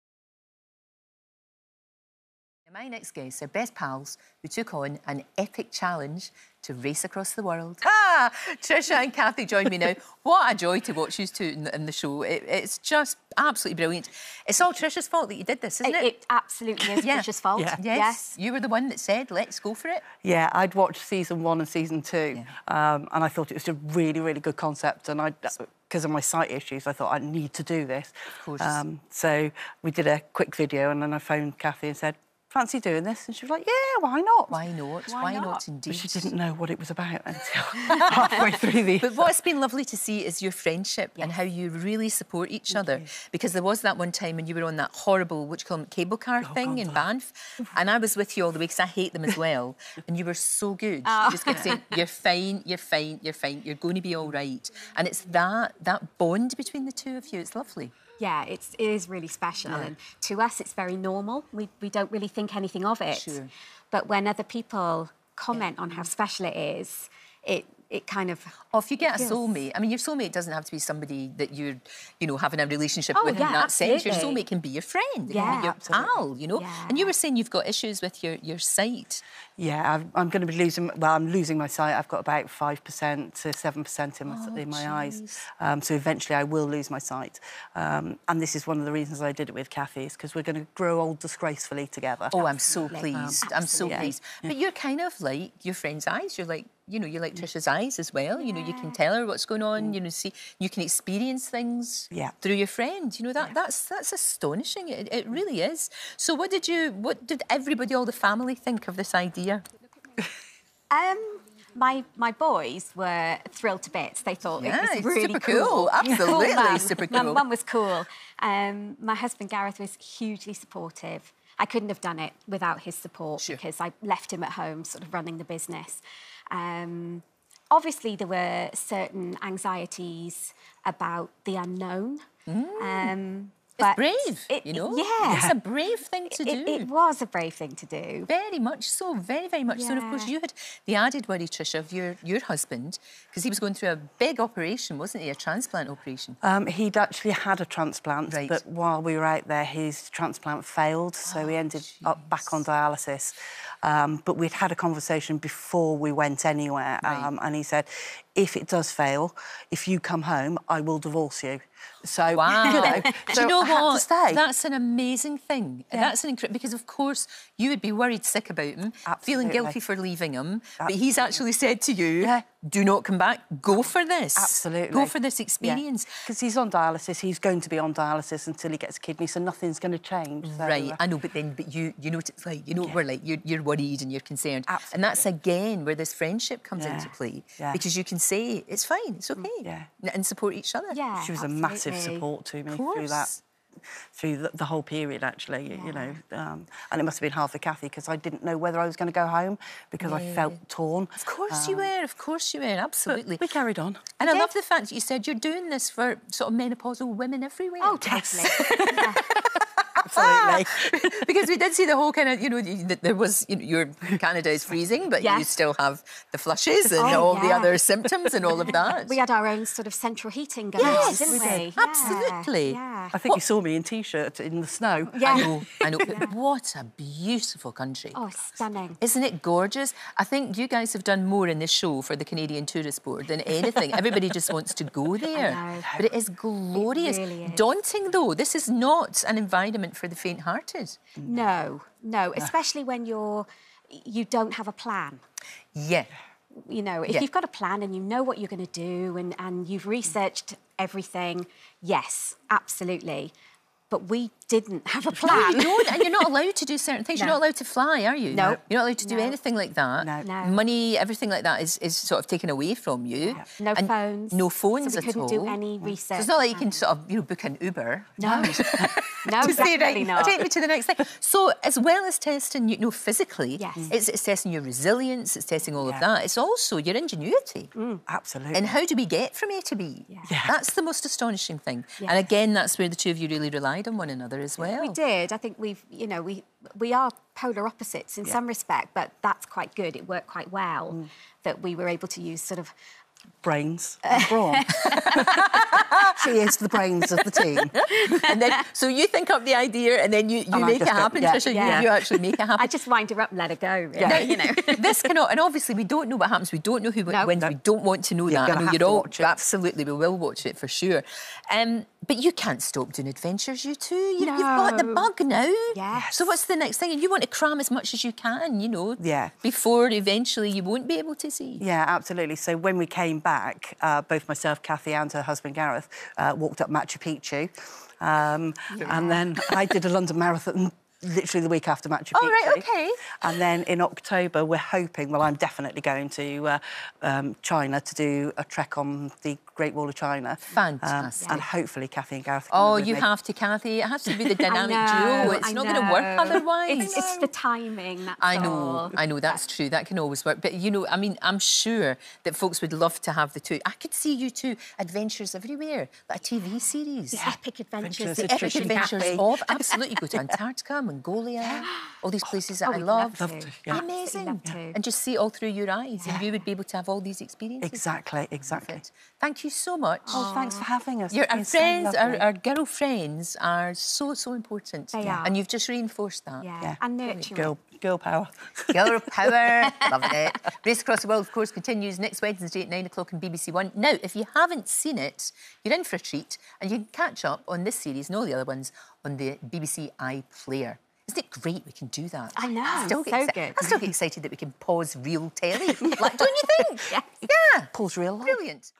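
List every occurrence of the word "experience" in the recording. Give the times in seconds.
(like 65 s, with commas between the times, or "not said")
100 s, 175 s, 367 s.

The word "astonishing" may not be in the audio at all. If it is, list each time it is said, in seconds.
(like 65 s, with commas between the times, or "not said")
104 s, 281 s.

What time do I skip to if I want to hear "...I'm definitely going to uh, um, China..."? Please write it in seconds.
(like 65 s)
335 s.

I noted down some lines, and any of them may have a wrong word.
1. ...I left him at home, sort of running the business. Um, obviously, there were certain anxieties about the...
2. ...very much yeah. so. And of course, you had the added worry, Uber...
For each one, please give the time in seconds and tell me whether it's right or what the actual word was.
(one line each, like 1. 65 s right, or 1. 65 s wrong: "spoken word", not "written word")
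1. 123 s right
2. 139 s wrong: "Tricia", not "Uber".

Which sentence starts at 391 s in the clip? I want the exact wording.
Isn't it great we can do that?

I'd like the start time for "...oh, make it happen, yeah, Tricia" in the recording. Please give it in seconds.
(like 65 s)
300 s.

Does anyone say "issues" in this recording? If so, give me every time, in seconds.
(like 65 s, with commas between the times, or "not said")
26 s, 77 s.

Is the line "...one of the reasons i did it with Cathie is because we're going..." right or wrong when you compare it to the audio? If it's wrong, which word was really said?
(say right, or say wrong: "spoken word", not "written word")
right.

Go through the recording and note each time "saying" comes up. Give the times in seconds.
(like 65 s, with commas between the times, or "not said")
51 s, 77 s.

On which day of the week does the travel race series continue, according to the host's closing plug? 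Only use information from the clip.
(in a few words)
Wednesday.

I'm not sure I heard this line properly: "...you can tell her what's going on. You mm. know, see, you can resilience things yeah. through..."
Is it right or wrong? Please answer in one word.
wrong.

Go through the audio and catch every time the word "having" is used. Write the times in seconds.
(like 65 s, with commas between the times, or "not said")
72 s, 370 s.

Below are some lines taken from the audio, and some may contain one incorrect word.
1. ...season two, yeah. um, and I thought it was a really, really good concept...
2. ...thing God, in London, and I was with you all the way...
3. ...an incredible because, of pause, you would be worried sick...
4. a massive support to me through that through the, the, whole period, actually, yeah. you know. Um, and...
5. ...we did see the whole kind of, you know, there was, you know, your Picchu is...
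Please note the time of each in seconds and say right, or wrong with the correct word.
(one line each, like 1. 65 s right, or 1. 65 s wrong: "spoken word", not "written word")
1. 21 s right
2. 46 s wrong: "Banff", not "London"
3. 166 s wrong: "course", not "pause"
4. 191 s right
5. 211 s wrong: "Canada", not "Picchu".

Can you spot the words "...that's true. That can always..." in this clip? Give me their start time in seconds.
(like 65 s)
349 s.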